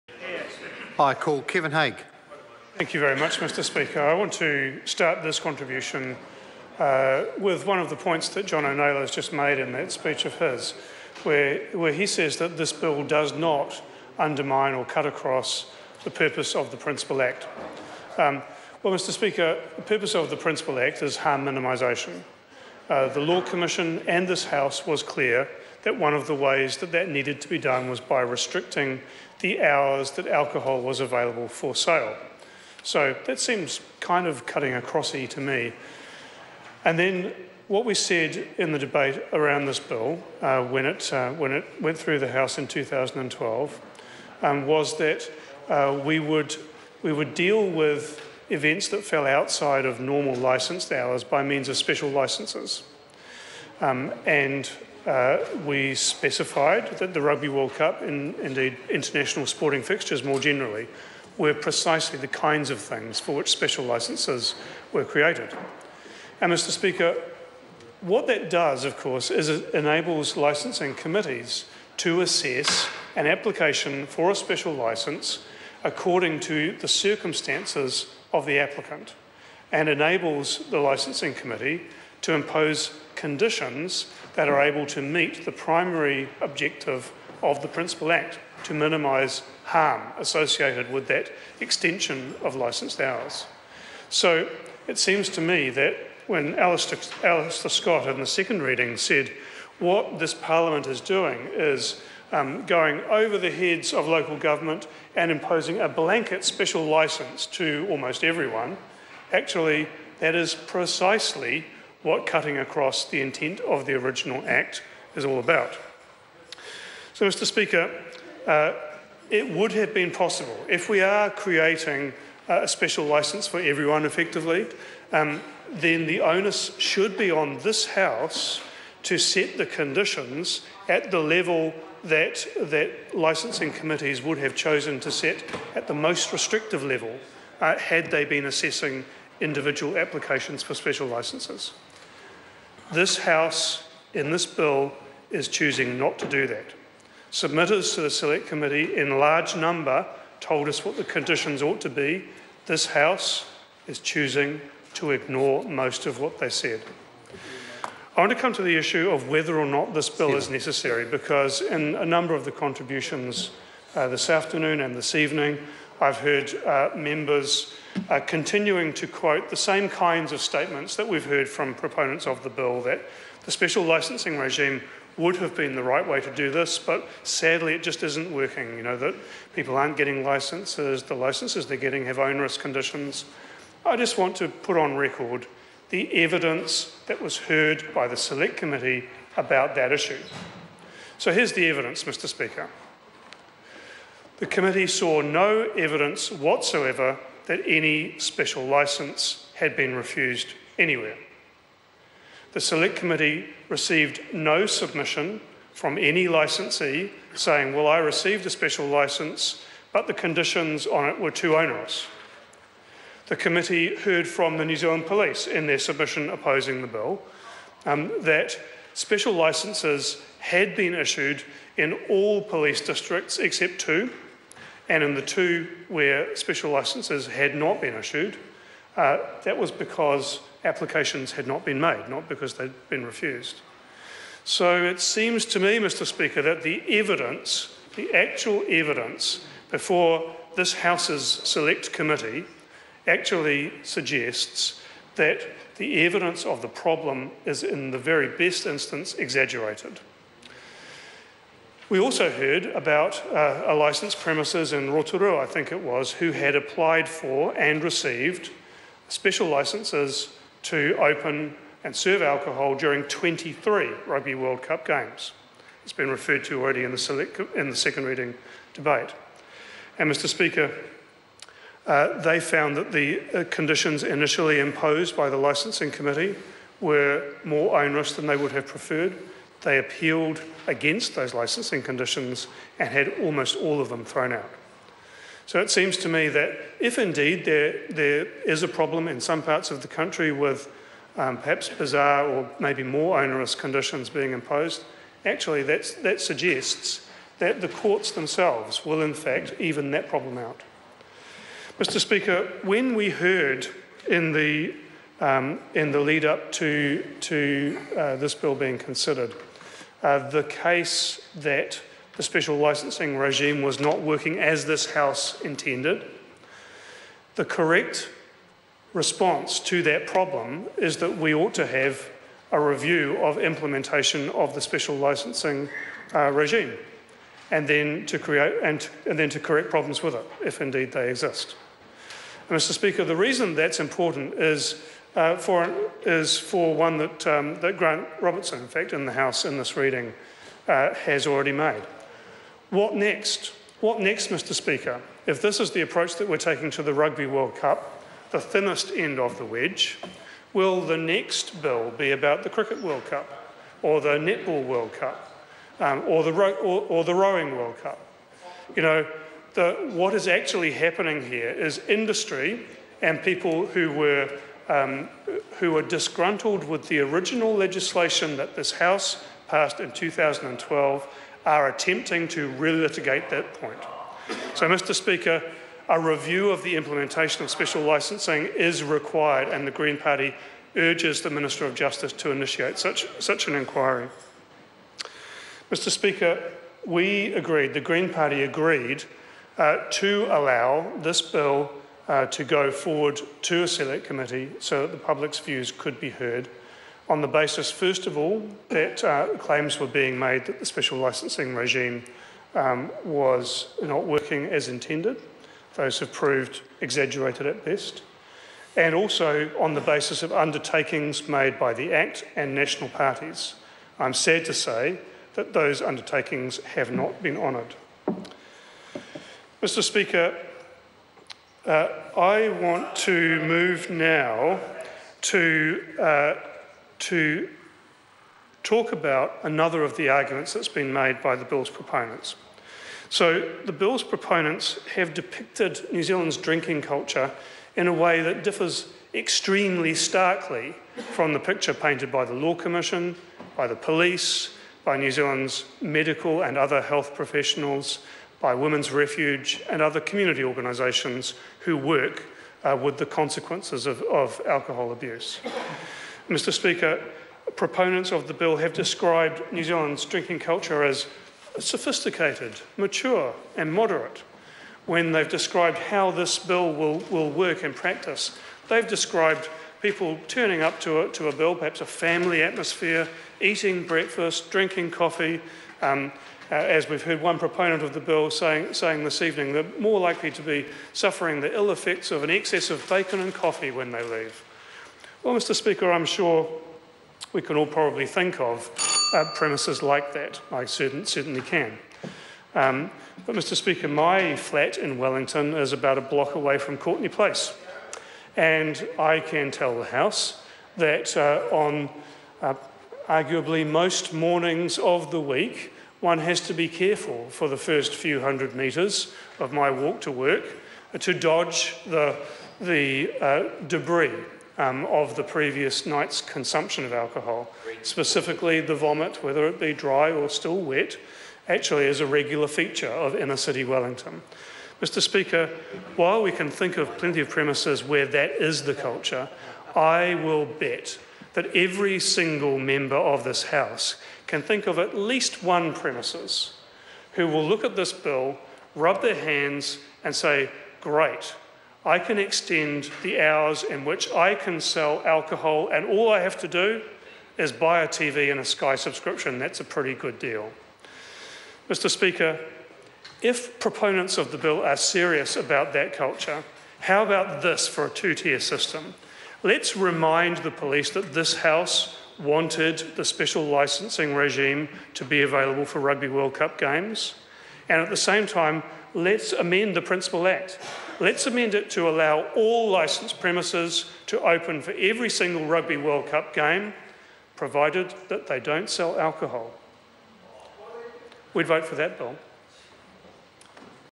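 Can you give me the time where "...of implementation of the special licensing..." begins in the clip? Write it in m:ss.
5:23.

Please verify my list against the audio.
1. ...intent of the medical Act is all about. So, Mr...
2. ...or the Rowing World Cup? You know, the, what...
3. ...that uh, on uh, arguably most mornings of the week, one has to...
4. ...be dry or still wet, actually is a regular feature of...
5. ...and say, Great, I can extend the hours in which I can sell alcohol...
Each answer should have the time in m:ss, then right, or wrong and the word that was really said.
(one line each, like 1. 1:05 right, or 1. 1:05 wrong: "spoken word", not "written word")
1. 1:53 wrong: "original", not "medical"
2. 5:56 right
3. 8:20 right
4. 8:39 right
5. 9:00 right.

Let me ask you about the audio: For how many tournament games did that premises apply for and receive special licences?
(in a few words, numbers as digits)
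23.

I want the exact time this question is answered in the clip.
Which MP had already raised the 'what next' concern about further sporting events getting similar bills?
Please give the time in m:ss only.
5:37.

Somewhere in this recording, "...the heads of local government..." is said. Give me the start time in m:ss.
1:43.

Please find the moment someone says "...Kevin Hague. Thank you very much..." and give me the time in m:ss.
0:01.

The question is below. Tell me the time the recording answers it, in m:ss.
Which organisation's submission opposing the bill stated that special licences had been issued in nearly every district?
3:34.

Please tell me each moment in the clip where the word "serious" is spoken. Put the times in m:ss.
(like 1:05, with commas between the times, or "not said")
9:14.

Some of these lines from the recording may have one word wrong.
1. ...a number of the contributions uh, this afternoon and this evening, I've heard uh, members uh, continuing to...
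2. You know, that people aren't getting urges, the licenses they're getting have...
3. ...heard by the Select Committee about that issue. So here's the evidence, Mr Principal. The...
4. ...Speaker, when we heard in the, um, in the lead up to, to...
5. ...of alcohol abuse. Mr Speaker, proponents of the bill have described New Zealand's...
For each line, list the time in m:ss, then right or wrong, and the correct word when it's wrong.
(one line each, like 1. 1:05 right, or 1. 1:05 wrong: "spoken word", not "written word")
1. 2:41 right
2. 2:58 wrong: "licenses", not "urges"
3. 3:07 wrong: "Speaker", not "Principal"
4. 5:01 right
5. 7:34 right.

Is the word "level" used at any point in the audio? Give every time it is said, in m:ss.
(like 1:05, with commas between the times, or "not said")
2:11, 2:16.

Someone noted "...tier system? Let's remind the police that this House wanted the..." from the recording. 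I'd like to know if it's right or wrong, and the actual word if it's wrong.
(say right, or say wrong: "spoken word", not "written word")
right.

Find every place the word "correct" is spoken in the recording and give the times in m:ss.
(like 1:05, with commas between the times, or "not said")
5:17, 5:29.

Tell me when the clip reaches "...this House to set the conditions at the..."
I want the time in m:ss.
2:07.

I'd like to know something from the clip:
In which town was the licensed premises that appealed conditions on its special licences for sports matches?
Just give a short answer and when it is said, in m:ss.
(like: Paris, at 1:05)
Rotorua, at 4:14.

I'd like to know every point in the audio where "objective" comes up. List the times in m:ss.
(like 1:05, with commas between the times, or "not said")
1:26.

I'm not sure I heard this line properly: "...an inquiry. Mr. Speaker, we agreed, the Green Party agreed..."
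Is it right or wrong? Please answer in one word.
right.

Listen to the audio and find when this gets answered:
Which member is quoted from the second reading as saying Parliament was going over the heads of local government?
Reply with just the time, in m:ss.
1:37.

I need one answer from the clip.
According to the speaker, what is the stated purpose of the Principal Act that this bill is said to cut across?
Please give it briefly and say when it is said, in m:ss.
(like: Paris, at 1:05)
Harm minimisation, at 0:21.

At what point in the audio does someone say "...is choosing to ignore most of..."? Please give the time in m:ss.
2:33.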